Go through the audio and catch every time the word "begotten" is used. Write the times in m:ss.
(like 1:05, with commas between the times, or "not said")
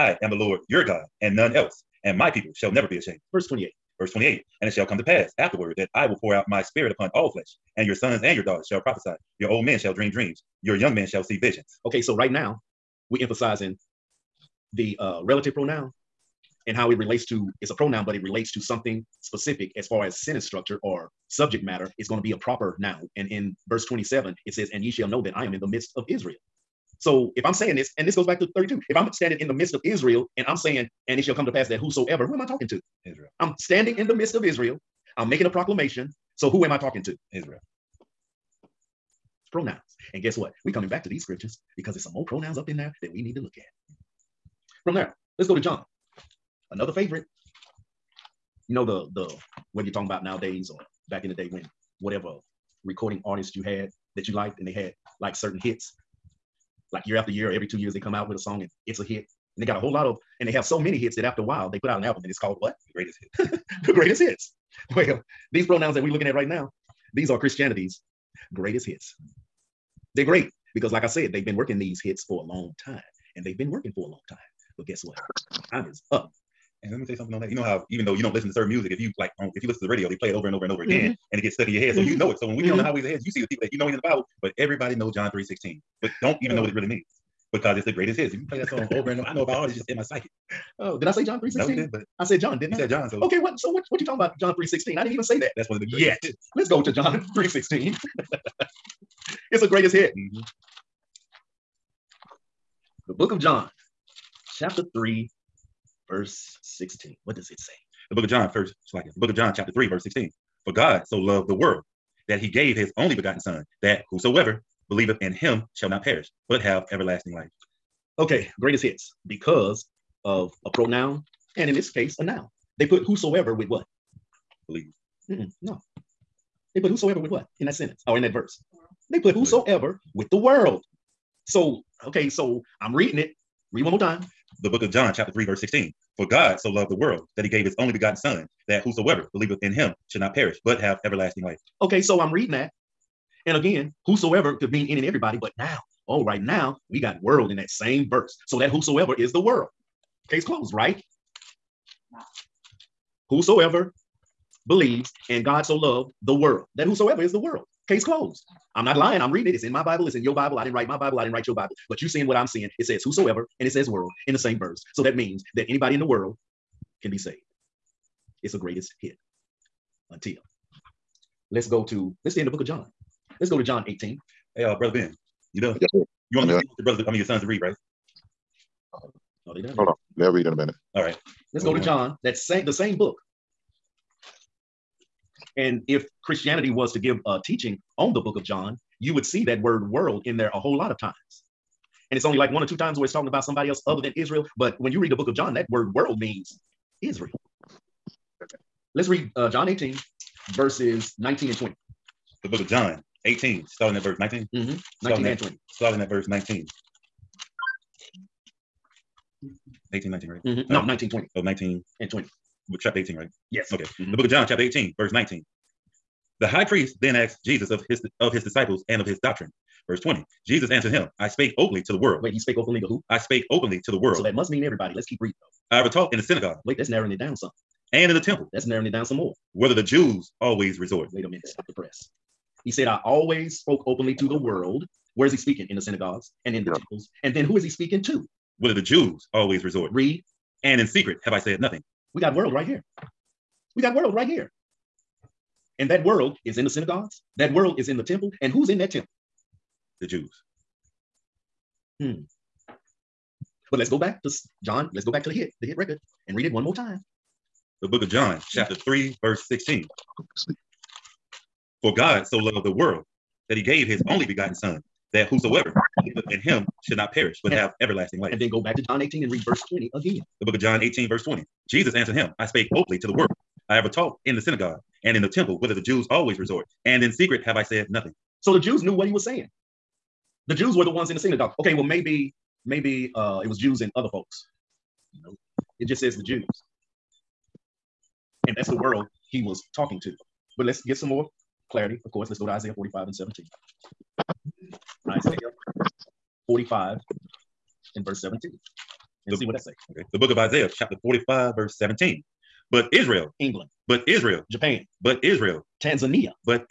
1:53, 2:17, 4:24.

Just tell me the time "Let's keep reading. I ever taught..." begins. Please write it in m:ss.
3:44.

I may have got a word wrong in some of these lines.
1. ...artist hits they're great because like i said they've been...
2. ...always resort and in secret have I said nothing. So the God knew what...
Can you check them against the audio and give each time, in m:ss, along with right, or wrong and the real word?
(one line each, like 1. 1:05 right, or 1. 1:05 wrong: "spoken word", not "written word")
1. 1:08 wrong: "greatest", not "artist"
2. 4:36 wrong: "Jews", not "God".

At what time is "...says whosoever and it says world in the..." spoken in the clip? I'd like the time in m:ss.
2:42.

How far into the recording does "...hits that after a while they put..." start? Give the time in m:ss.
1:00.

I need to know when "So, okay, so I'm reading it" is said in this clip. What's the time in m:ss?
2:11.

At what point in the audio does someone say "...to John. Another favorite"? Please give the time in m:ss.
0:45.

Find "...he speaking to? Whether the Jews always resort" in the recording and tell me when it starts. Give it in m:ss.
3:57.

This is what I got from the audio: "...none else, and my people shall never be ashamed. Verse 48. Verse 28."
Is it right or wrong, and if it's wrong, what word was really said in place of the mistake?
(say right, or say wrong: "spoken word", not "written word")
wrong: "28", not "48".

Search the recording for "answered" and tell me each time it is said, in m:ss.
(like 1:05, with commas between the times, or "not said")
3:40, 4:31.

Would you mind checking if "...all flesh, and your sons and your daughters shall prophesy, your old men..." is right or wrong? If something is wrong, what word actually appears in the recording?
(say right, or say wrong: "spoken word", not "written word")
right.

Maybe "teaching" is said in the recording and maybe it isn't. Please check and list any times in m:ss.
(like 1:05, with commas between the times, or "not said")
3:07.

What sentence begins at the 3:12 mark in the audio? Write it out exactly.
And it's only like one or two times where it's talking about somebody else other than Israel.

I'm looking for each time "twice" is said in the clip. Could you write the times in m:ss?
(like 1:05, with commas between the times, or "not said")
not said.